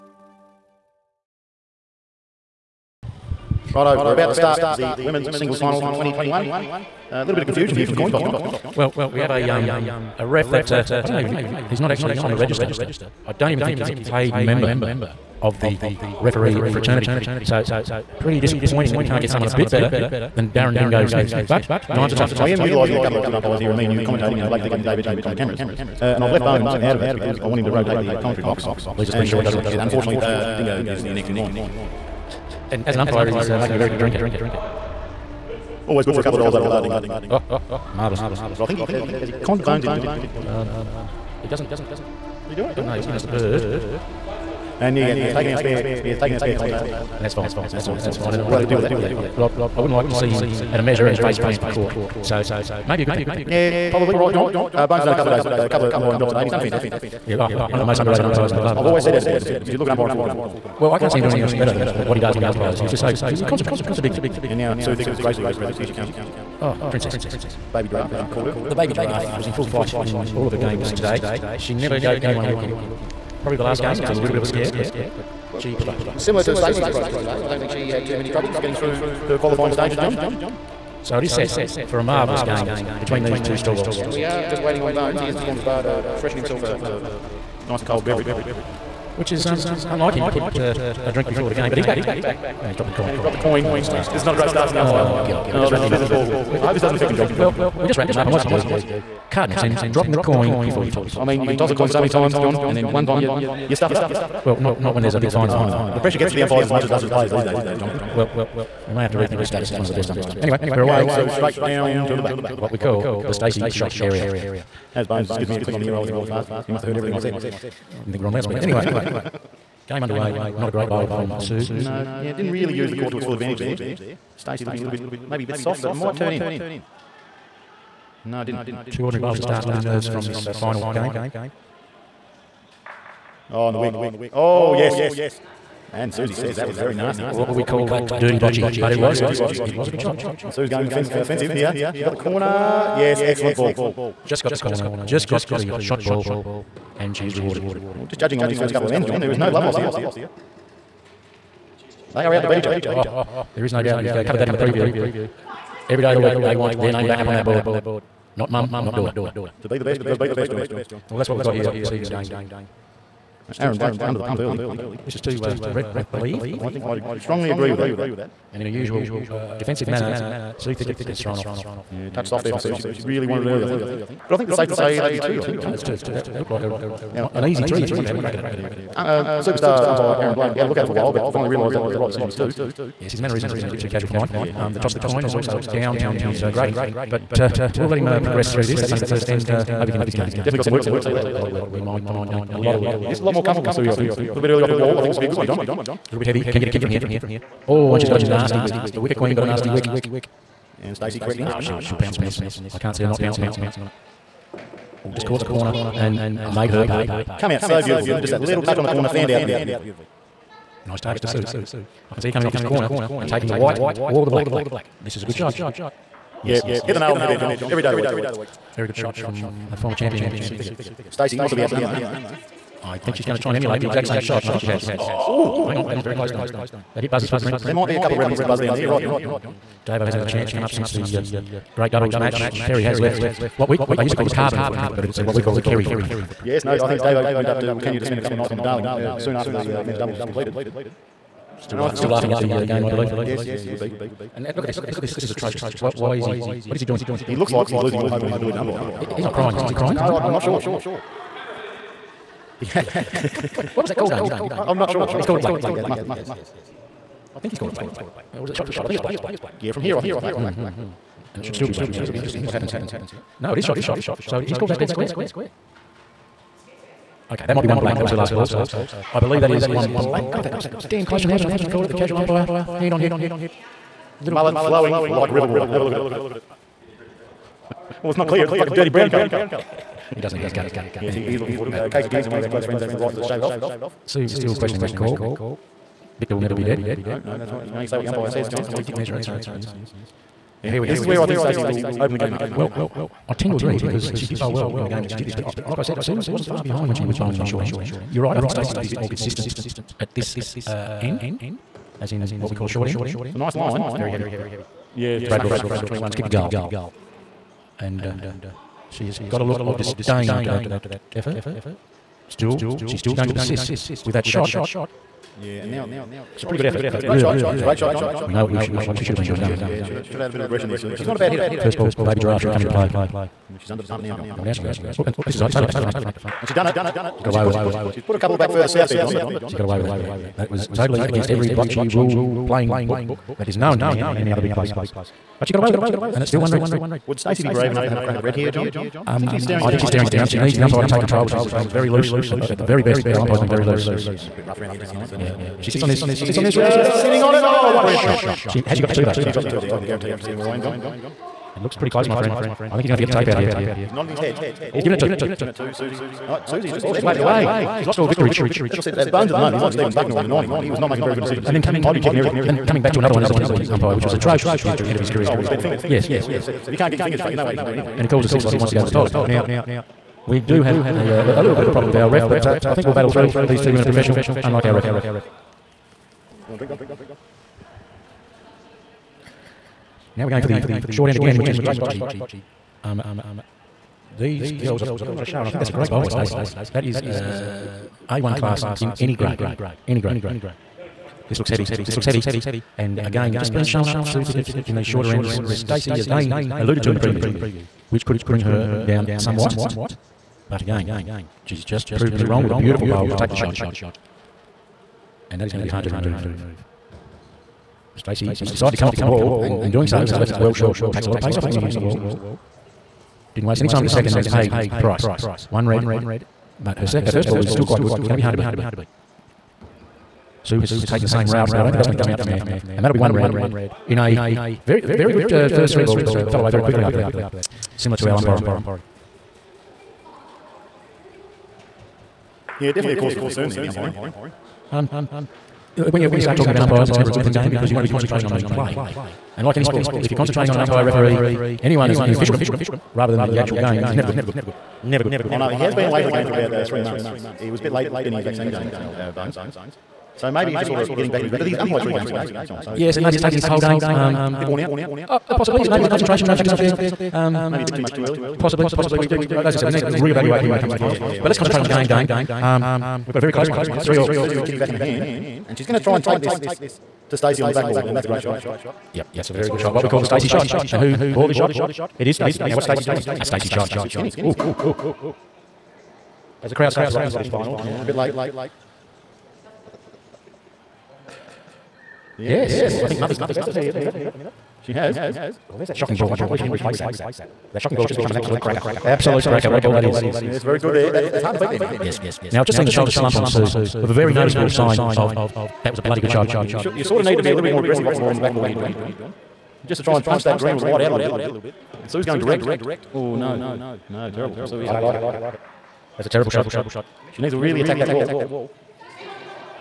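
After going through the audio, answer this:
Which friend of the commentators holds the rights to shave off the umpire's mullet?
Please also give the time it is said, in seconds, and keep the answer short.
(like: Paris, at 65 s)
Casey Jansen, at 281 s.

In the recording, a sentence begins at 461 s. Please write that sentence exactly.
Yeah, yeah, but let's concentrate on the game, Dane.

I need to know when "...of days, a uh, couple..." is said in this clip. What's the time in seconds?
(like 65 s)
55 s.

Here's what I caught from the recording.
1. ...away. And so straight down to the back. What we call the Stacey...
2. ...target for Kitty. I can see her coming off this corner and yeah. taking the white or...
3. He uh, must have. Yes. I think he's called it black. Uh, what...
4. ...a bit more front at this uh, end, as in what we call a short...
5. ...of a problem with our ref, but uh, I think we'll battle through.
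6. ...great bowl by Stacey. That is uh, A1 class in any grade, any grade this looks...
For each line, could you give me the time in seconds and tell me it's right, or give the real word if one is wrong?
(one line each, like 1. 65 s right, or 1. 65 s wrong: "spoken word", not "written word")
1. 110 s right
2. 210 s wrong: "Sue", not "Kitty"
3. 255 s right
4. 298 s wrong: "consistent", not "front"
5. 371 s right
6. 385 s right.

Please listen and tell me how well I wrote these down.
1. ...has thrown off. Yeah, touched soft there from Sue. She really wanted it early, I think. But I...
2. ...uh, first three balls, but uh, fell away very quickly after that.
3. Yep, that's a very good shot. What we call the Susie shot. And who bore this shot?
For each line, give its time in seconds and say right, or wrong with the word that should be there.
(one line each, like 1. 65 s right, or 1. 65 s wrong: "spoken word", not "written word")
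1. 171 s right
2. 425 s right
3. 468 s wrong: "Stacey", not "Susie".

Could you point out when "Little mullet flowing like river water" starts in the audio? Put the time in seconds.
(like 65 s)
274 s.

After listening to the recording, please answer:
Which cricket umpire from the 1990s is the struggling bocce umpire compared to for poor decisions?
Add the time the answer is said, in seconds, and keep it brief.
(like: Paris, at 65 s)
Stephen Bucknor, at 359 s.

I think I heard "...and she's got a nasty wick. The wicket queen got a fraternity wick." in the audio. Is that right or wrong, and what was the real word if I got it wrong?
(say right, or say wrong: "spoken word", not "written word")
wrong: "nasty", not "fraternity".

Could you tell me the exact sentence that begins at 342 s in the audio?
At, uh, at, the very best, our umpire's been very loose.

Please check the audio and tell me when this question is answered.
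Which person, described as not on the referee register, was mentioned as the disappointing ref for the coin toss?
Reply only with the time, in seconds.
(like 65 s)
20 s.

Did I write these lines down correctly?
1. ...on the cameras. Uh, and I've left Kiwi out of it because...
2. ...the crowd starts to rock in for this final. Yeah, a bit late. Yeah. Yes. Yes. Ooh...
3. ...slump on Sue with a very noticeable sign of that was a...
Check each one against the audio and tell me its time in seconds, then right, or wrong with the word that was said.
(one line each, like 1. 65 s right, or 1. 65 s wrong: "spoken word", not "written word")
1. 25 s wrong: "Bones", not "Kiwi"
2. 476 s right
3. 492 s right.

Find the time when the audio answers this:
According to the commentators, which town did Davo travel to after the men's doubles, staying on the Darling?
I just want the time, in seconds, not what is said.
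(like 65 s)
237 s.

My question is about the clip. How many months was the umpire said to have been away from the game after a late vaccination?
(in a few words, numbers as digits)
3.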